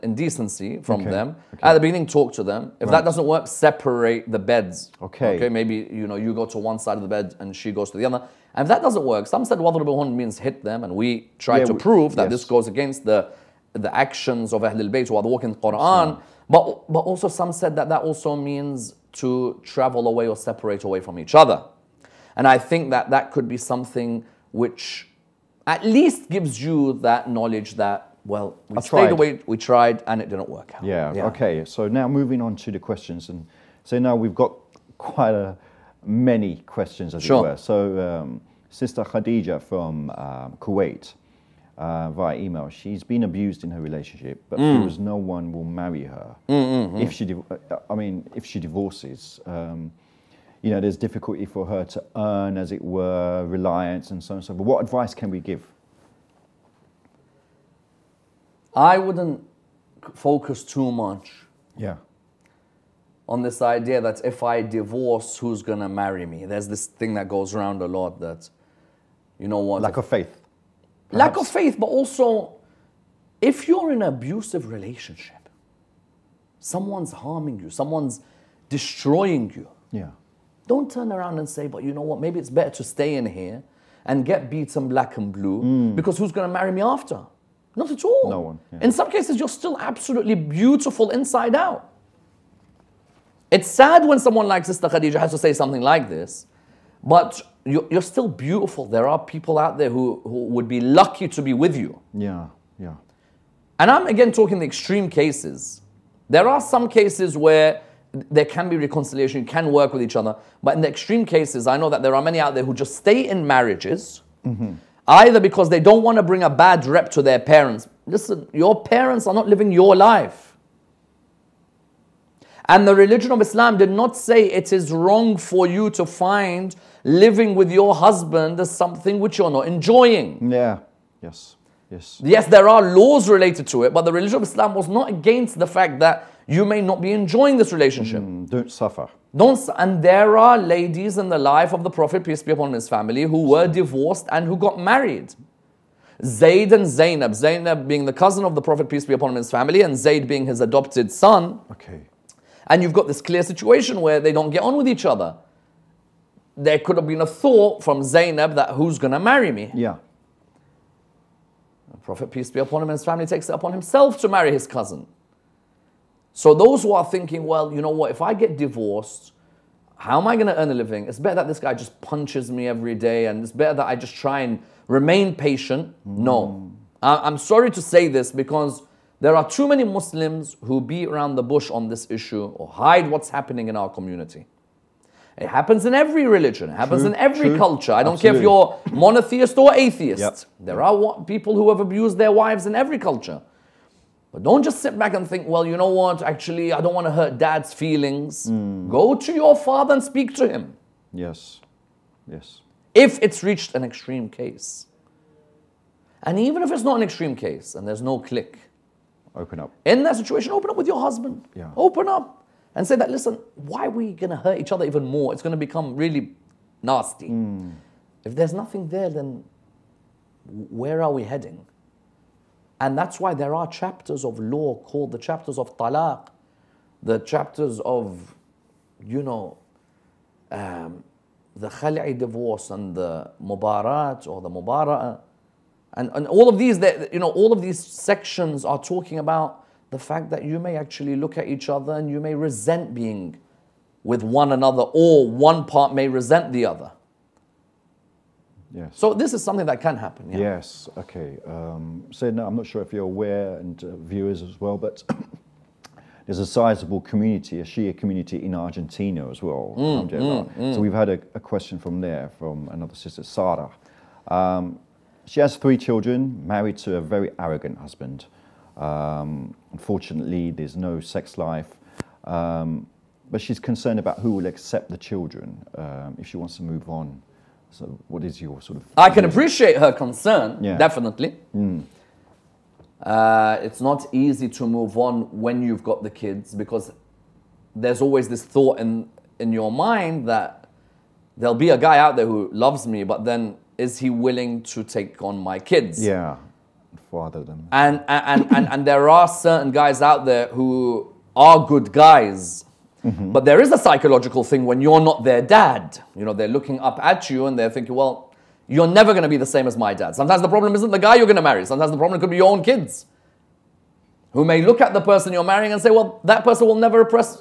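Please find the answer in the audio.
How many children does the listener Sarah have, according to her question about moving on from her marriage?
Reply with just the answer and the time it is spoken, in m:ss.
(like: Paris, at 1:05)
3, at 4:25.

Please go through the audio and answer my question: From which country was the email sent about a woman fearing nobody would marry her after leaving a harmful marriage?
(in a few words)
Kuwait.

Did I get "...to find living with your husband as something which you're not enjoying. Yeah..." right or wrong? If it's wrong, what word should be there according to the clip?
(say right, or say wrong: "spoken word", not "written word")
right.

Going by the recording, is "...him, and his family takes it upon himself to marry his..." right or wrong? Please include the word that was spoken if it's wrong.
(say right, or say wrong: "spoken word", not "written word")
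right.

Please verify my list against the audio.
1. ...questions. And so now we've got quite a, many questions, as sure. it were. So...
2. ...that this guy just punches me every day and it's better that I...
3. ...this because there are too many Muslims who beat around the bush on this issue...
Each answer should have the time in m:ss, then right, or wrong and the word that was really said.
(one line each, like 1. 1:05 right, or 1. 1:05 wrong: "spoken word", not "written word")
1. 0:32 right
2. 2:51 right
3. 2:58 right.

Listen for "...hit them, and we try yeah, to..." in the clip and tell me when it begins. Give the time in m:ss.
0:10.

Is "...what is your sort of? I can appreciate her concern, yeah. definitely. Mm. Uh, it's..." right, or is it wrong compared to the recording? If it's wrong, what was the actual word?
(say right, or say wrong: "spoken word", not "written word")
right.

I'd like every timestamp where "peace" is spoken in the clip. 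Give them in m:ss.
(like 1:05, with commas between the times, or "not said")
2:22, 2:28, 2:42.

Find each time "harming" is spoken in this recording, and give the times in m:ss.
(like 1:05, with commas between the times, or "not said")
1:17.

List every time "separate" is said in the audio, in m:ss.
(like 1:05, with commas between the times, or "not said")
0:03, 0:20.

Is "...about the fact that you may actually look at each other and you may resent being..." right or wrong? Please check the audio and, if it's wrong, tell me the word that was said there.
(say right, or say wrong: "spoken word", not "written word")
right.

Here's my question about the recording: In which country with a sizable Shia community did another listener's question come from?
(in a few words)
Argentina.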